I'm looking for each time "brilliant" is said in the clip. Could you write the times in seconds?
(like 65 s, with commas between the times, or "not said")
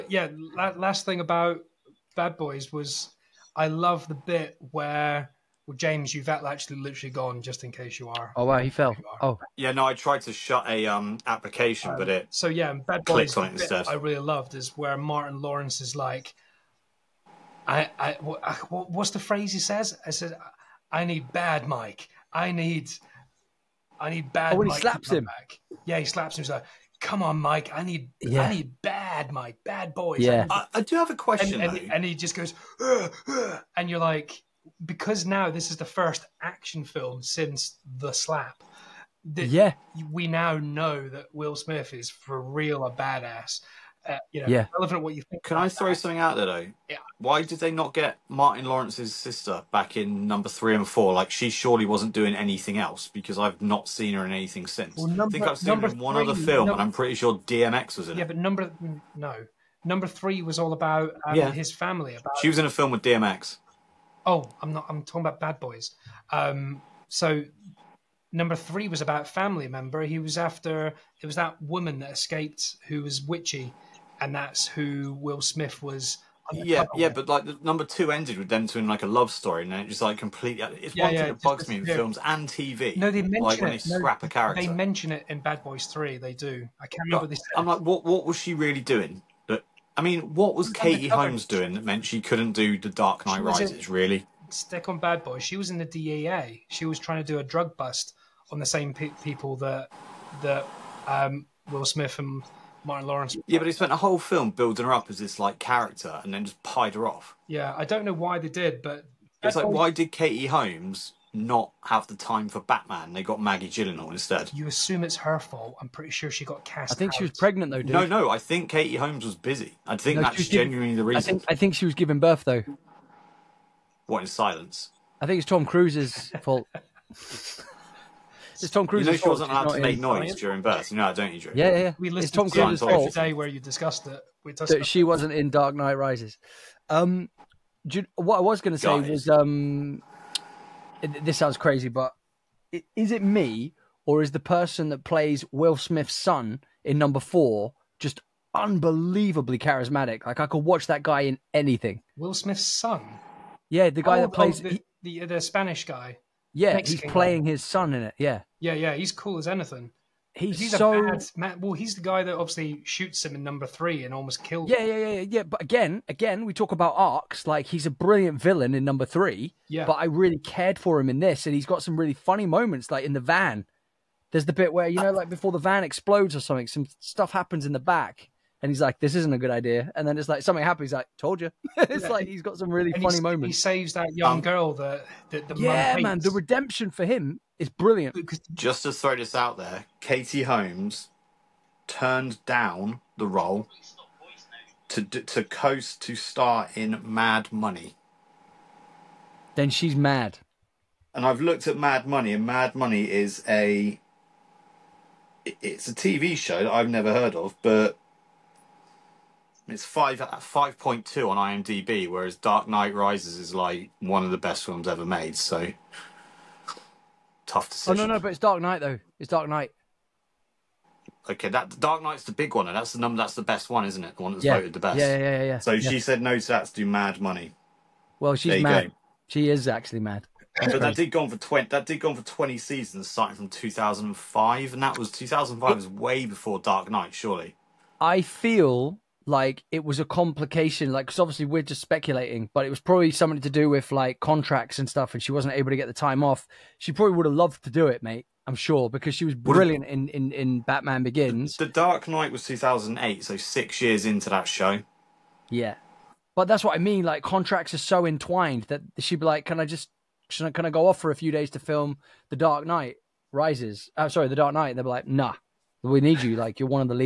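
167 s, 187 s, 249 s.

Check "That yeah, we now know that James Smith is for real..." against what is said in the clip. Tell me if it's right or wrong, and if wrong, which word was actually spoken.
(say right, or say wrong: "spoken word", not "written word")
wrong: "Will", not "James".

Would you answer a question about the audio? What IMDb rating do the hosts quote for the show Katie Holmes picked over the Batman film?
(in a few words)
5.2.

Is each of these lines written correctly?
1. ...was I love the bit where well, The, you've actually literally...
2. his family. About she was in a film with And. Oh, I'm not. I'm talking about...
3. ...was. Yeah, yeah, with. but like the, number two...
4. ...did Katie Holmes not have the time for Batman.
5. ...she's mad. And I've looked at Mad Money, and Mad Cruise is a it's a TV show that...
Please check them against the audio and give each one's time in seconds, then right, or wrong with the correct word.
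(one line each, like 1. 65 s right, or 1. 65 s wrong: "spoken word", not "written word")
1. 2 s wrong: "James", not "The"
2. 61 s wrong: "DMX", not "And"
3. 75 s right
4. 109 s right
5. 199 s wrong: "Money", not "Cruise".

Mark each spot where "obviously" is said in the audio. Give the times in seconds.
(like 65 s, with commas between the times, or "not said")
162 s, 241 s.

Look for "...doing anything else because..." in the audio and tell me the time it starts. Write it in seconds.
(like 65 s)
52 s.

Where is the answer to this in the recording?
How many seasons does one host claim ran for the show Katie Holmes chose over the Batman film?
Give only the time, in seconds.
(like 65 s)
232 s.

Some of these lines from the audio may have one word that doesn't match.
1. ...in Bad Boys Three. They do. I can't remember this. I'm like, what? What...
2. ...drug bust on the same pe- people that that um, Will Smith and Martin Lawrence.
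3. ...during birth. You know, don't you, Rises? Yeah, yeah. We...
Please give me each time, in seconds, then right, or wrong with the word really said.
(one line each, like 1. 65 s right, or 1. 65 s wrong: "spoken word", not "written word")
1. 85 s right
2. 97 s right
3. 130 s wrong: "Drew", not "Rises".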